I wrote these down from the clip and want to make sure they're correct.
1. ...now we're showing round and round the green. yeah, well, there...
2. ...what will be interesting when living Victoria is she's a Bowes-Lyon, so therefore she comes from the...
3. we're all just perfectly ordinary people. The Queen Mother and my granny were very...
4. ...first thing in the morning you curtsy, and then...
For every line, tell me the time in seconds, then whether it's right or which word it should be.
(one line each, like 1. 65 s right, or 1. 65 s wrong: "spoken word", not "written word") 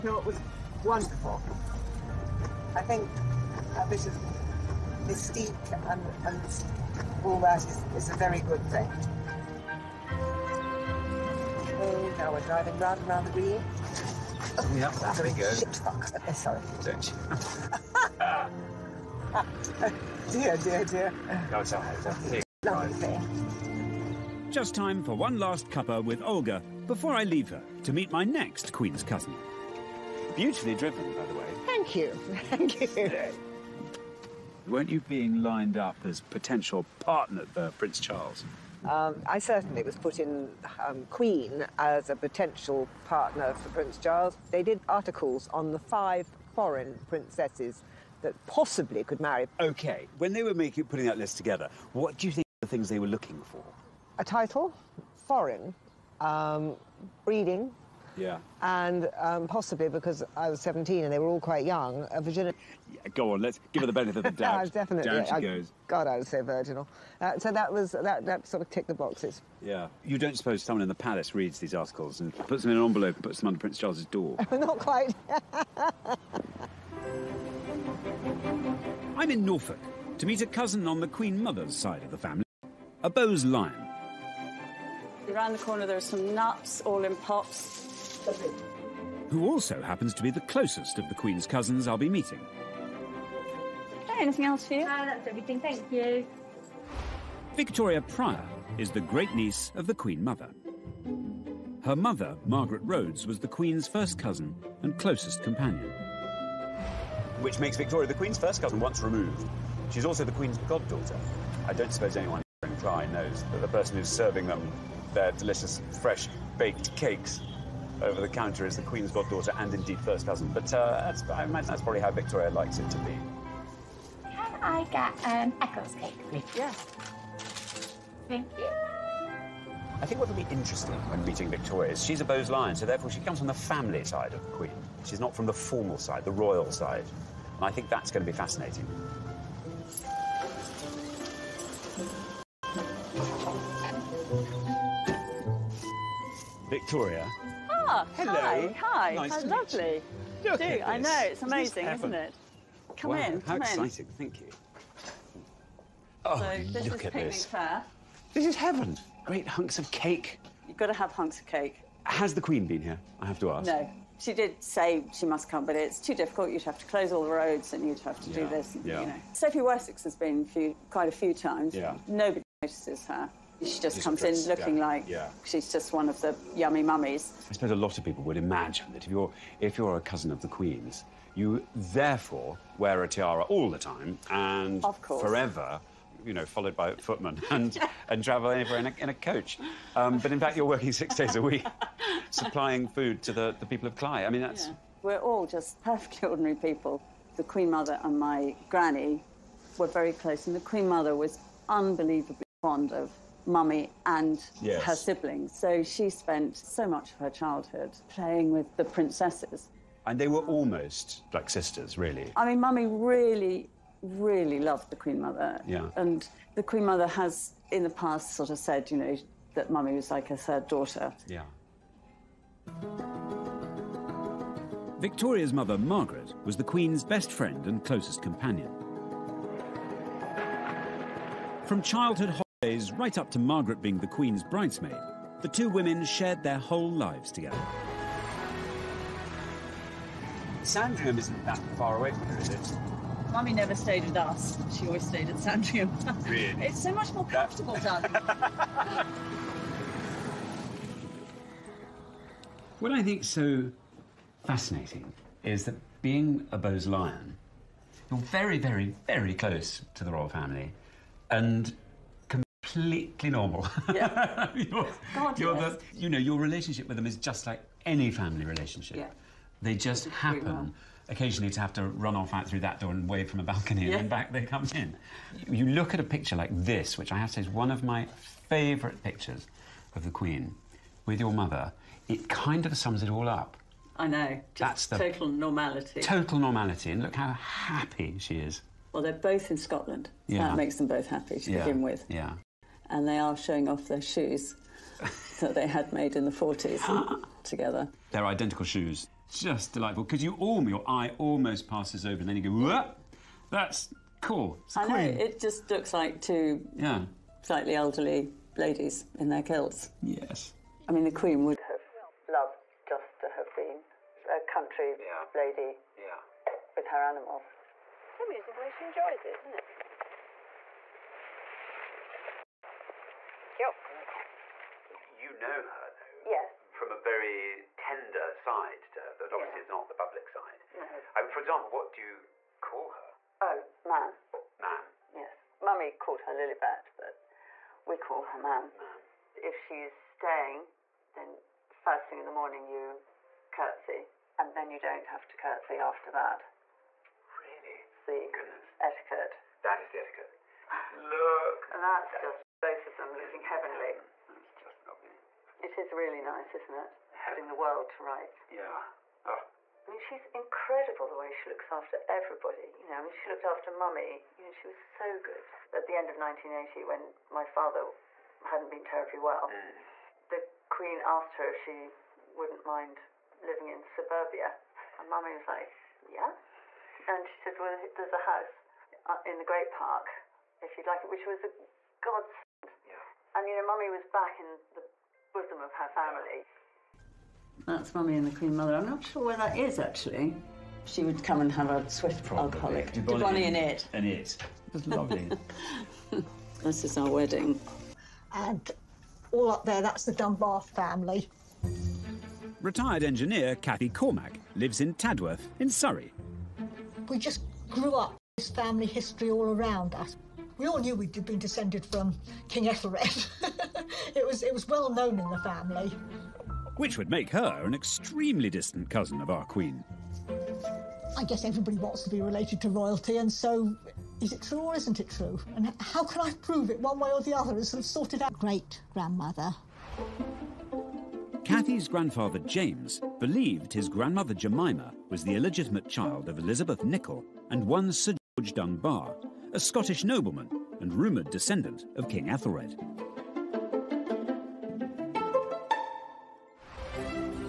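1. 12 s wrong: "driving", not "showing"
2. 130 s wrong: "meeting", not "living"
3. 195 s right
4. 341 s right.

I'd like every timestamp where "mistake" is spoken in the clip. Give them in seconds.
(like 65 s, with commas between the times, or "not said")
not said.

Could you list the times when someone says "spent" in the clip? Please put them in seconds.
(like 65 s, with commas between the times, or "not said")
206 s.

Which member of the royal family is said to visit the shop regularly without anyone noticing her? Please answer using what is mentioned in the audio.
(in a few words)
Sophie Wessex.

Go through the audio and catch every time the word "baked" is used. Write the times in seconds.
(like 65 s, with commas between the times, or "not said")
116 s.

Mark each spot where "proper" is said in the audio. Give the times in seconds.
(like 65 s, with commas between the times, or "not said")
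not said.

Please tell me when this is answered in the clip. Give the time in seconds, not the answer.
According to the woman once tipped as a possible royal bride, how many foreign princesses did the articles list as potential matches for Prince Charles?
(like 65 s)
45 s.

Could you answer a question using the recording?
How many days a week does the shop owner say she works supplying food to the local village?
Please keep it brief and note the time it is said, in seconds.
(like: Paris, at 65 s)
6, at 190 s.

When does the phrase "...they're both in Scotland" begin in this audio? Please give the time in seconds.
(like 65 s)
289 s.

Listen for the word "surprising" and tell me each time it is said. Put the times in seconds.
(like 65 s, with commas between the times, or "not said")
not said.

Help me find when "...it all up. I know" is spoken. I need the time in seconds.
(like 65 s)
283 s.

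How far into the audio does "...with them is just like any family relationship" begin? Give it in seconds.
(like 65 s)
266 s.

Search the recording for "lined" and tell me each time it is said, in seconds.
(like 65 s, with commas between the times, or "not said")
35 s.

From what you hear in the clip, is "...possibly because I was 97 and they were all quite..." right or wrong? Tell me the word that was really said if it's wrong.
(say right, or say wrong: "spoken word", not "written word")
wrong: "17", not "97".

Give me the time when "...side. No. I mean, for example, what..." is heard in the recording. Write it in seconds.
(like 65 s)
330 s.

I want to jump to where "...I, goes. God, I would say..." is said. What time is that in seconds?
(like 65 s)
65 s.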